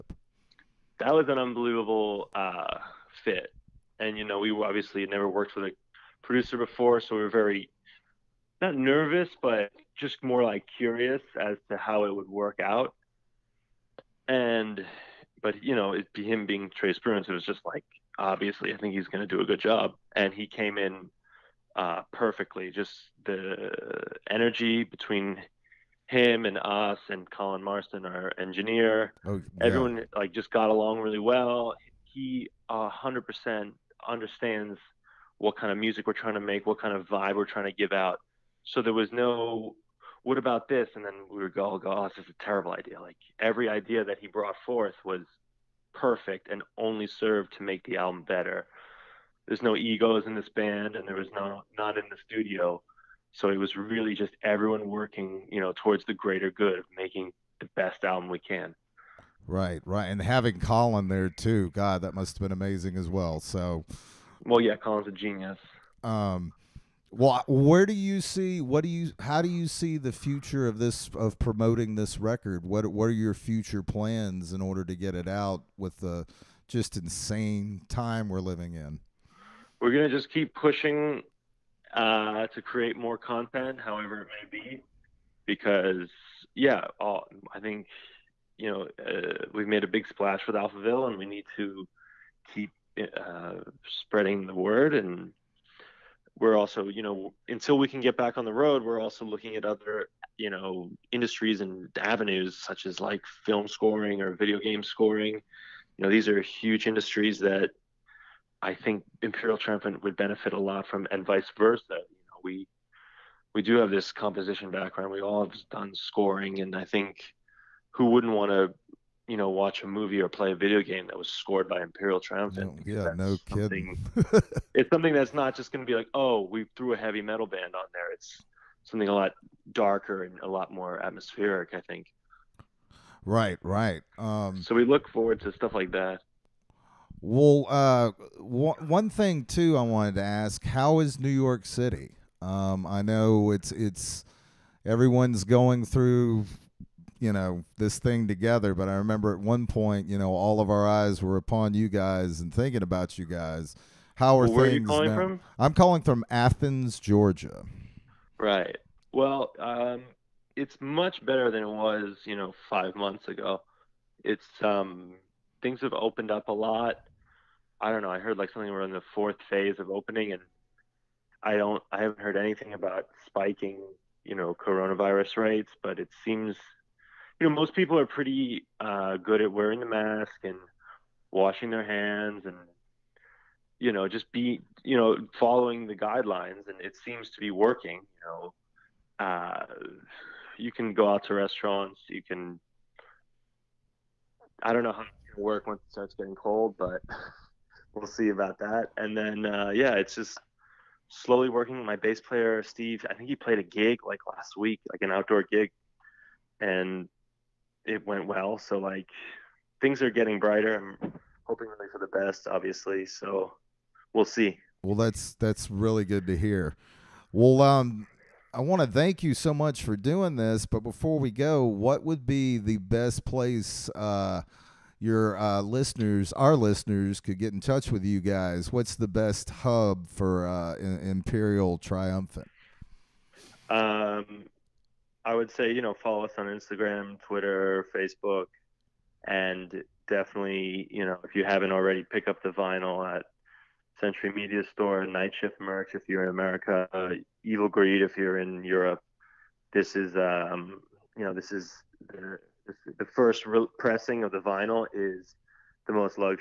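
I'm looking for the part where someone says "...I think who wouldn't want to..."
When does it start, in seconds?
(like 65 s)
116 s.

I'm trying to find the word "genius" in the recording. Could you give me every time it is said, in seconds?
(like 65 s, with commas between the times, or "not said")
65 s.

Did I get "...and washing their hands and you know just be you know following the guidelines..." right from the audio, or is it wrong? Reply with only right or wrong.
right.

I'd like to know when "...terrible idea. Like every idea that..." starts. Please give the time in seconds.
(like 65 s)
42 s.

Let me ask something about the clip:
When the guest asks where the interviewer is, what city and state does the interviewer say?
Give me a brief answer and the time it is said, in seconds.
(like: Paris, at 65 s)
Athens, Georgia, at 156 s.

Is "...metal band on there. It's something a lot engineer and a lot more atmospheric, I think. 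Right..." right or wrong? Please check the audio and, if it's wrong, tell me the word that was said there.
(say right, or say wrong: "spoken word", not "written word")
wrong: "darker", not "engineer".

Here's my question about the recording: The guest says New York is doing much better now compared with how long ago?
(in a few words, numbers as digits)
5 months ago.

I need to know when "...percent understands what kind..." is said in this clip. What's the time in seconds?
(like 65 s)
33 s.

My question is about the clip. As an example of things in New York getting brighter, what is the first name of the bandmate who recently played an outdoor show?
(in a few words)
Steve.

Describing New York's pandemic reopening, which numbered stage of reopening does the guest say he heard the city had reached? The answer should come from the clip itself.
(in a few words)
4th phase.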